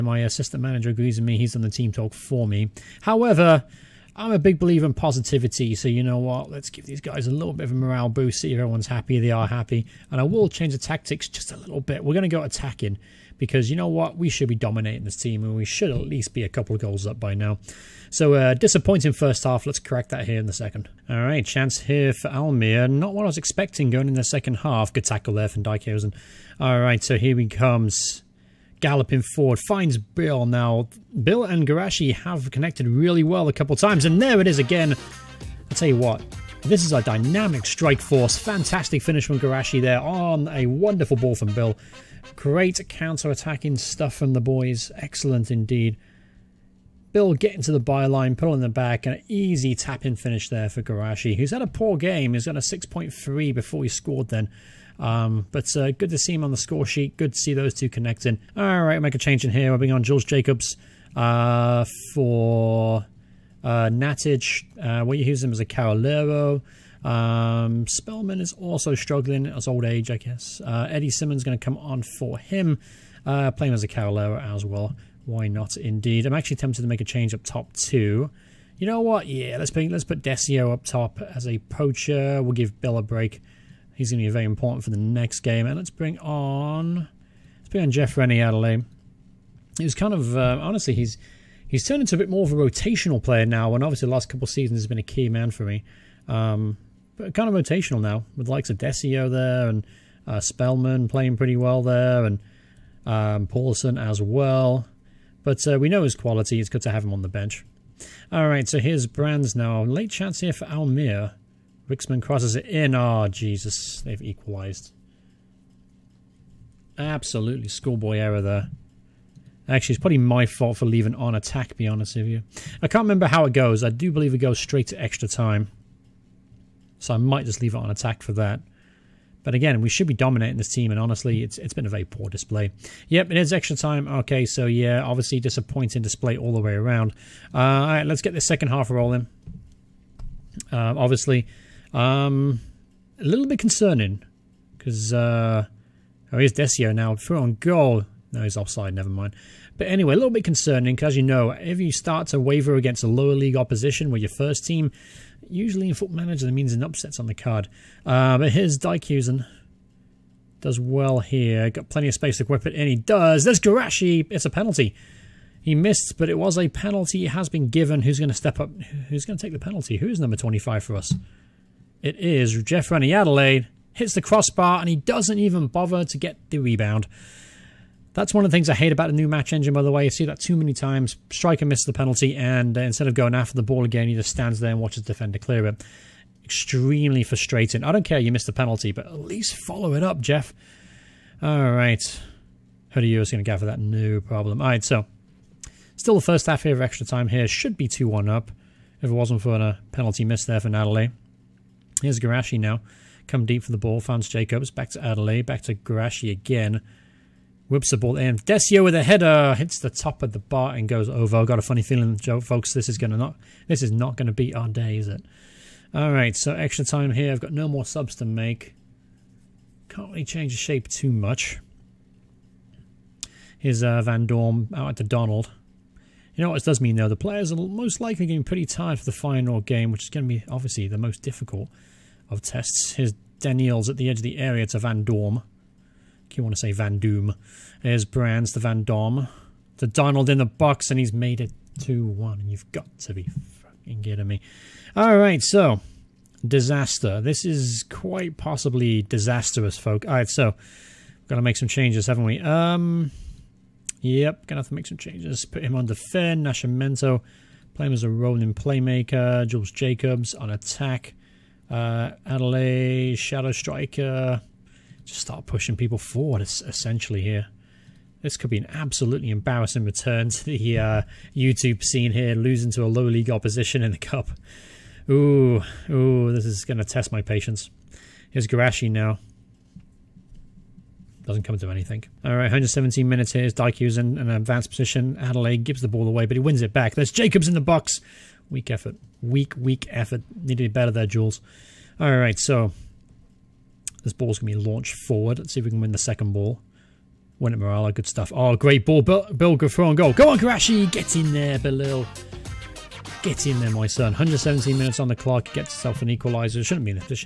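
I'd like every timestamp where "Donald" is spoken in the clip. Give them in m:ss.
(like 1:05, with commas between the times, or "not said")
3:45, 3:59.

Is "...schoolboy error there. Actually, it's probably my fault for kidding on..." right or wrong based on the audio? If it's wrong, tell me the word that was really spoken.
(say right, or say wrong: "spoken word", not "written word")
wrong: "leaving", not "kidding".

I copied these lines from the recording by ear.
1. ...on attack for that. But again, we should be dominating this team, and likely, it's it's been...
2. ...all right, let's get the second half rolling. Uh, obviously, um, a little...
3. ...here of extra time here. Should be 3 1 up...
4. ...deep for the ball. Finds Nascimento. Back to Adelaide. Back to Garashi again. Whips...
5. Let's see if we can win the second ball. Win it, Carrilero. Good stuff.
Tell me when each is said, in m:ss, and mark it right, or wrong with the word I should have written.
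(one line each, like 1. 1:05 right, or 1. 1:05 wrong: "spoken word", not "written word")
1. 2:07 wrong: "honestly", not "likely"
2. 2:17 right
3. 3:16 wrong: "2", not "3"
4. 3:23 wrong: "Jacobs", not "Nascimento"
5. 4:55 wrong: "Morala", not "Carrilero".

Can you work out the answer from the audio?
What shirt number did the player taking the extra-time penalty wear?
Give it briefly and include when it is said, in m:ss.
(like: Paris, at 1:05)
25, at 2:50.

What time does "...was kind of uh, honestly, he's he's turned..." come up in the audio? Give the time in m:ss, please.
1:29.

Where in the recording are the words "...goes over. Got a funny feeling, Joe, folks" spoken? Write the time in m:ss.
3:30.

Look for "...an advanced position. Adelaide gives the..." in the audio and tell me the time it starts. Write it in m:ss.
4:44.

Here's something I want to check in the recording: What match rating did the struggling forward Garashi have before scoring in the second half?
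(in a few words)
6.3.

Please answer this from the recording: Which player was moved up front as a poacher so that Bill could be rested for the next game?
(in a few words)
Decio.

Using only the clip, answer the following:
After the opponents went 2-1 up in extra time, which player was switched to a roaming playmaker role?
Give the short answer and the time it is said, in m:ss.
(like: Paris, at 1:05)
Nascimento, at 4:16.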